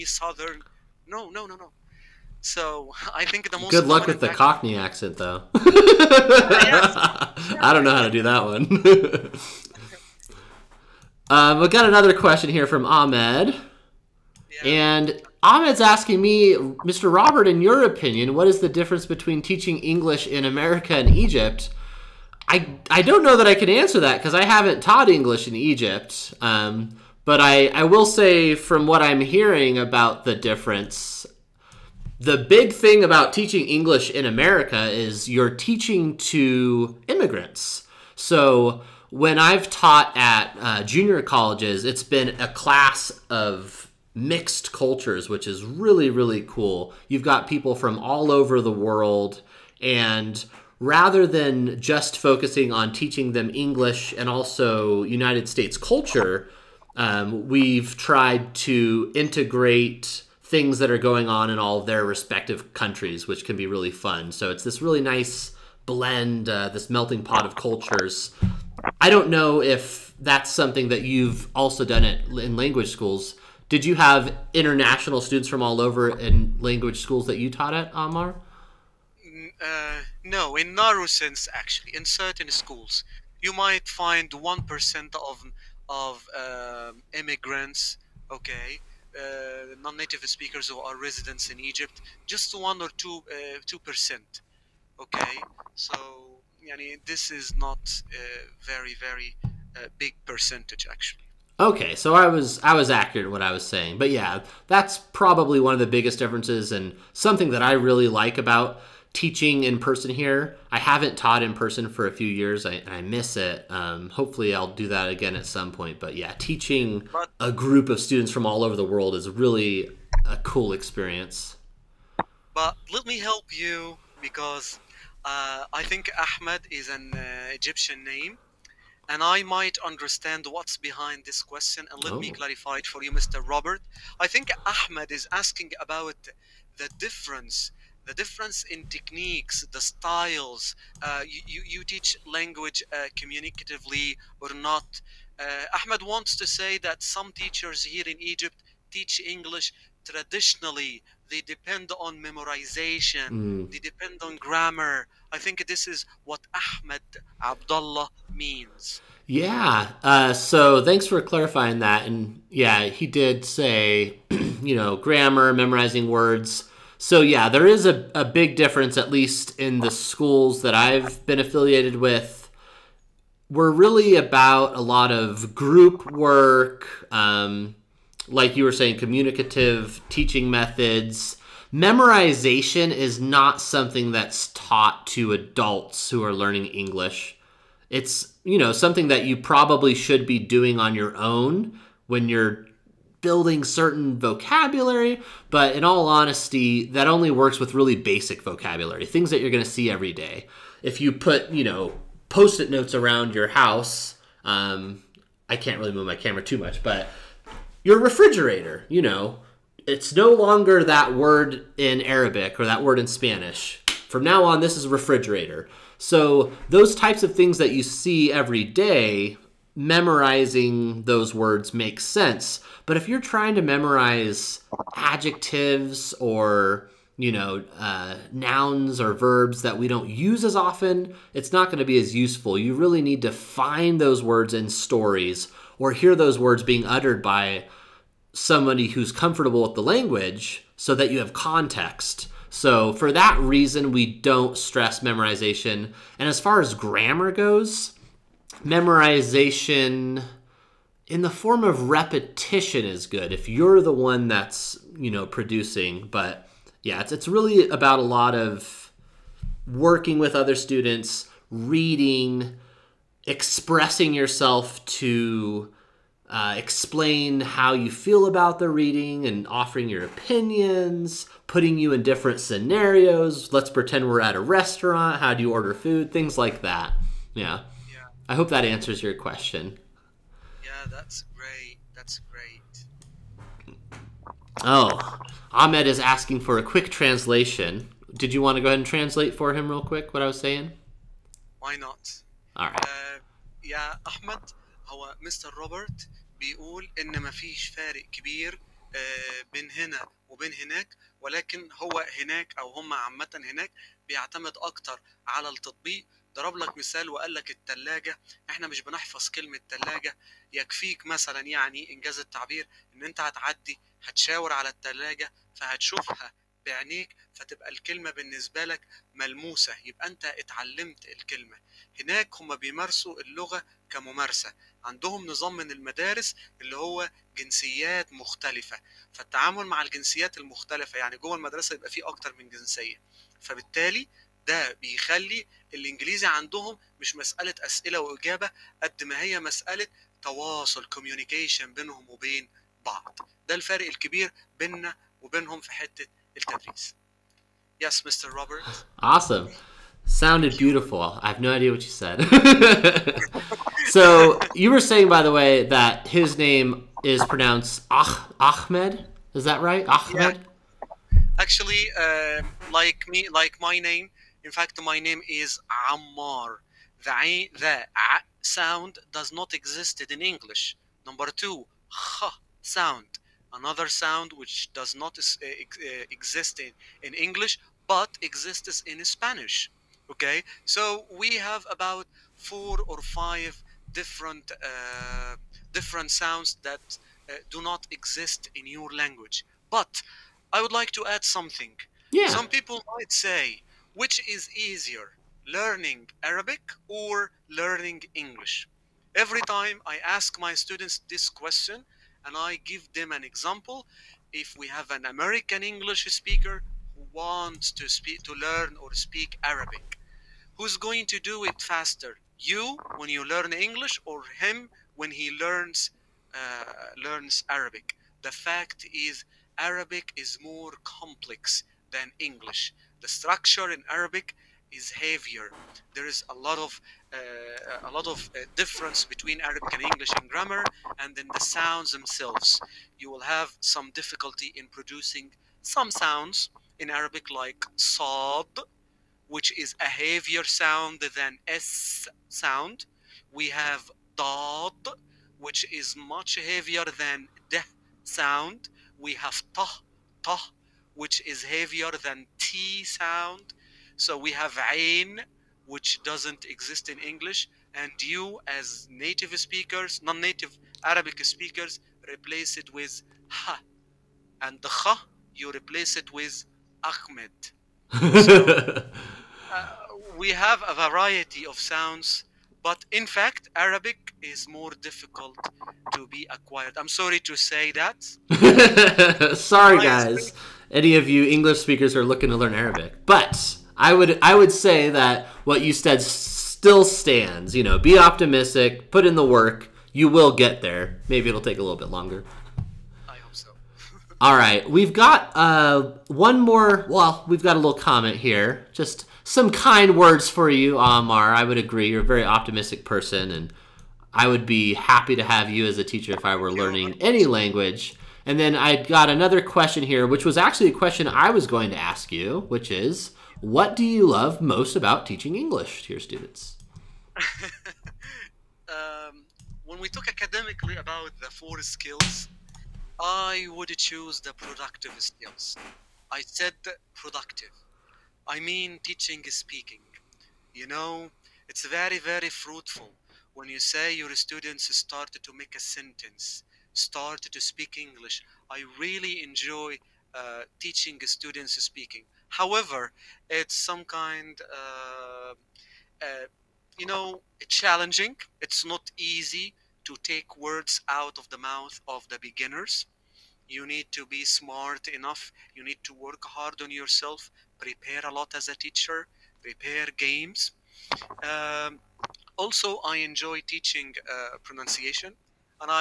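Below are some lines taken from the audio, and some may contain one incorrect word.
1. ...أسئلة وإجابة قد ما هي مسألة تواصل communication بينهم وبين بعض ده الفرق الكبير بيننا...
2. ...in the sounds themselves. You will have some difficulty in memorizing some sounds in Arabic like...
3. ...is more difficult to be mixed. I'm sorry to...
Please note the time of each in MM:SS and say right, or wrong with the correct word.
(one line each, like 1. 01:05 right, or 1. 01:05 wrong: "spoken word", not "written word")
1. 05:37 right
2. 07:11 wrong: "producing", not "memorizing"
3. 07:54 wrong: "acquired", not "mixed".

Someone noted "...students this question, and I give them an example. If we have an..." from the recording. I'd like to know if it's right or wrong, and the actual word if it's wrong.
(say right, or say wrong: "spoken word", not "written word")
right.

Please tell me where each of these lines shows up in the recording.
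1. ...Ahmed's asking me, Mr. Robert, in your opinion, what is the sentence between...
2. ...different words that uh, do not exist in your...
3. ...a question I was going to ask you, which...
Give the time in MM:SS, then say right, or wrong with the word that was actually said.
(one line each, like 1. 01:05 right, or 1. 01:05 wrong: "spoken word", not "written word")
1. 00:15 wrong: "difference", not "sentence"
2. 06:25 wrong: "sounds", not "words"
3. 08:30 right.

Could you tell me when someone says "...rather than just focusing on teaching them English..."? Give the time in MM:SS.
00:50.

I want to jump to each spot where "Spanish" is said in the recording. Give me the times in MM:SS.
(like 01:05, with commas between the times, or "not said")
03:33, 06:19.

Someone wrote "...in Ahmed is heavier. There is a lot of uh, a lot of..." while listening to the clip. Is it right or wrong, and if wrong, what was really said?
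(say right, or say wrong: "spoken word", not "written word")
wrong: "Arabic", not "Ahmed".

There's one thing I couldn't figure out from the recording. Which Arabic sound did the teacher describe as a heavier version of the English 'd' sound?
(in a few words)
dad.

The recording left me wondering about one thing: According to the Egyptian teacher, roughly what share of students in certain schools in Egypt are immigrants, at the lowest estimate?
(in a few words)
1 percent.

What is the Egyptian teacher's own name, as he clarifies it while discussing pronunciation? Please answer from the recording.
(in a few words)
Ammar.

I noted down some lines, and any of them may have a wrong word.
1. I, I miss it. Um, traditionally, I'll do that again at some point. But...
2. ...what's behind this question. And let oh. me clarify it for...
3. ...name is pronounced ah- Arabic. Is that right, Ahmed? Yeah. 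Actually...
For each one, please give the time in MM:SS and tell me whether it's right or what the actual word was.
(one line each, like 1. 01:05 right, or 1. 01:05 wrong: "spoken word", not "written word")
1. 01:52 wrong: "hopefully", not "traditionally"
2. 02:10 right
3. 05:56 wrong: "Ahmed", not "Arabic".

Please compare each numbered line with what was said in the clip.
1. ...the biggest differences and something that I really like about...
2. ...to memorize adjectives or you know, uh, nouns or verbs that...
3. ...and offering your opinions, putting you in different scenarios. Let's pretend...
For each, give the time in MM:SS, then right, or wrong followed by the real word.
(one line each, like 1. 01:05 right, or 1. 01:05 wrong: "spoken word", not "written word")
1. 01:45 right
2. 03:43 right
3. 04:29 right.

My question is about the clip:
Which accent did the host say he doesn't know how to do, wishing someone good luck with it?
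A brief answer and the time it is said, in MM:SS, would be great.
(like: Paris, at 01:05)
Cockney, at 00:04.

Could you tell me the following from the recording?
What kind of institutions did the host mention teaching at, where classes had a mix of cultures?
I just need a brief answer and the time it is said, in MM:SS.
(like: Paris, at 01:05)
junior colleges, at 00:40.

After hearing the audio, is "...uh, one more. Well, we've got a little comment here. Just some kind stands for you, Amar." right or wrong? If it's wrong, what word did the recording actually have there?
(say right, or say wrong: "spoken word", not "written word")
wrong: "words", not "stands".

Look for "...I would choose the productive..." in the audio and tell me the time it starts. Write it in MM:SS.
08:42.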